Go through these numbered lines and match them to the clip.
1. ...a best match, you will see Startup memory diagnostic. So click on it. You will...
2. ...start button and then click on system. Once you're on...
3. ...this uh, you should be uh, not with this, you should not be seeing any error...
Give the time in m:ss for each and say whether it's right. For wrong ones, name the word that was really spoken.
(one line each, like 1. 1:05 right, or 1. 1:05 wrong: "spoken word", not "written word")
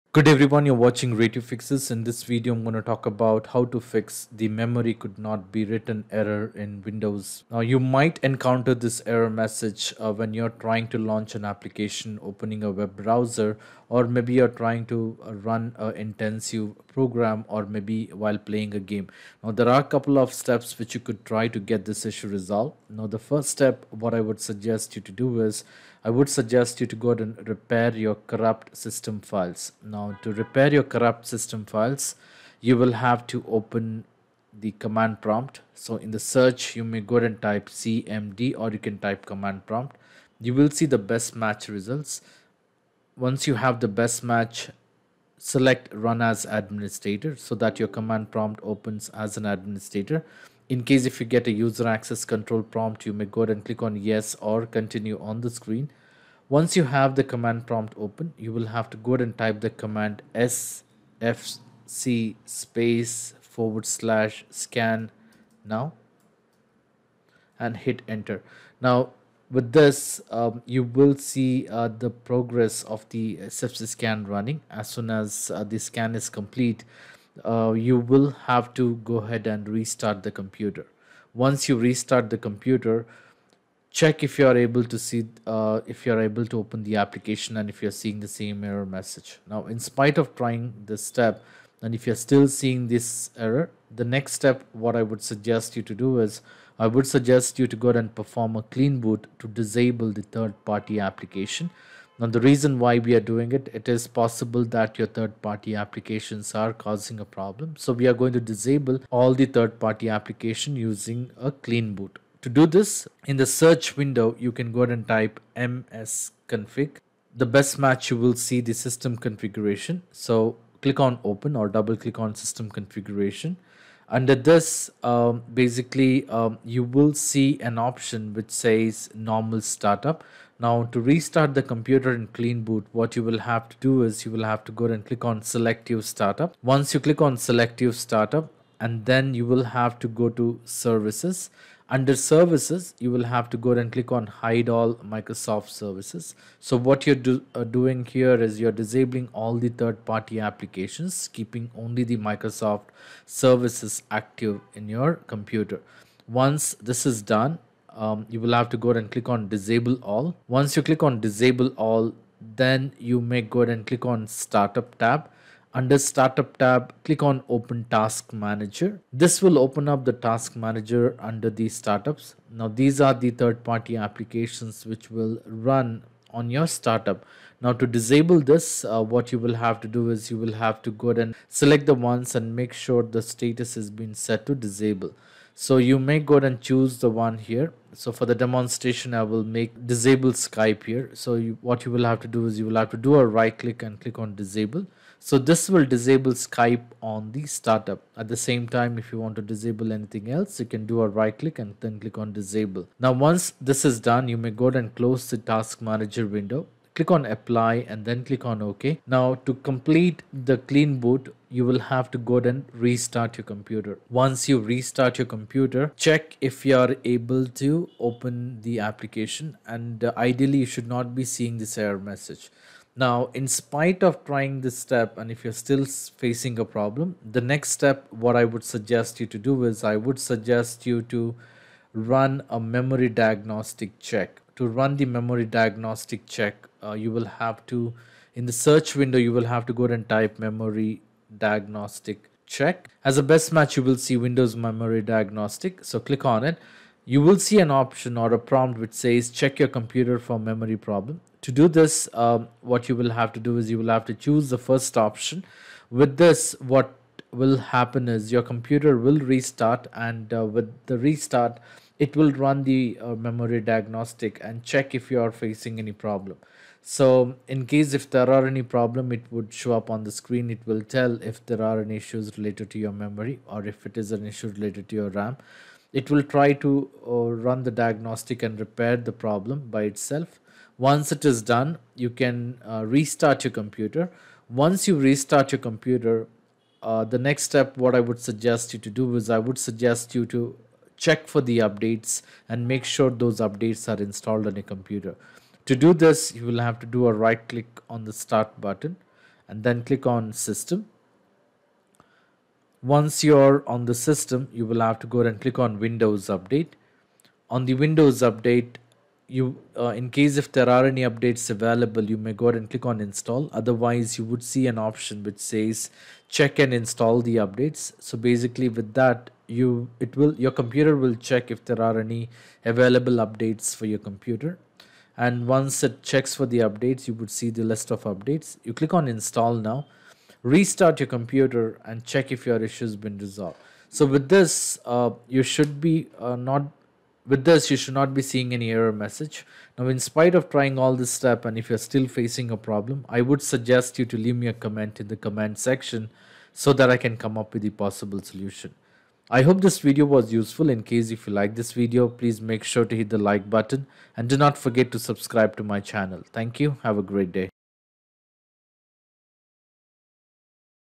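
1. 4:03 wrong: "Windows", not "Startup"
2. 4:58 right
3. 5:34 right.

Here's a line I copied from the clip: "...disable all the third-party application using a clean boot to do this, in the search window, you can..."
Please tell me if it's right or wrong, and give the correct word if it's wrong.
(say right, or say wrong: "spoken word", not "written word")
right.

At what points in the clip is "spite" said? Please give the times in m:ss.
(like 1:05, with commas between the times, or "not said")
1:29, 3:43, 5:39.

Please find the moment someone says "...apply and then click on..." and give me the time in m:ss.
3:27.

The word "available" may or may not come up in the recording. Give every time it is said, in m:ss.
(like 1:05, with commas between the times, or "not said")
5:11, 5:22.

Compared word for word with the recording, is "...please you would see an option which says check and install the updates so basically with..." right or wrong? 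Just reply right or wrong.
wrong.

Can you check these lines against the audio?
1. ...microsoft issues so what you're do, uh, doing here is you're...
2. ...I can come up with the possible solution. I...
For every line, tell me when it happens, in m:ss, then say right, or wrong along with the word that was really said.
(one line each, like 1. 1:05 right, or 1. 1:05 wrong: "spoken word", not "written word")
1. 2:25 wrong: "services", not "issues"
2. 5:46 right.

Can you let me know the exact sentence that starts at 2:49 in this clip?
This will open up the Task Manager under the startups.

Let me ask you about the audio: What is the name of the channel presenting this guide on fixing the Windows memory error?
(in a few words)
Ray Tube Fixes.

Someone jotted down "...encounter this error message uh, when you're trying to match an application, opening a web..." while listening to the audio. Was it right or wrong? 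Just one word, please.
wrong.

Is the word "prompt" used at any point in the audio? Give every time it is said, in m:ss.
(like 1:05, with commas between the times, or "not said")
0:35, 0:39, 0:48, 0:52, 0:57, 4:08.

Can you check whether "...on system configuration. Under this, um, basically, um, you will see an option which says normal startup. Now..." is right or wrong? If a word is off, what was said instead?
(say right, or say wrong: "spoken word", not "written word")
right.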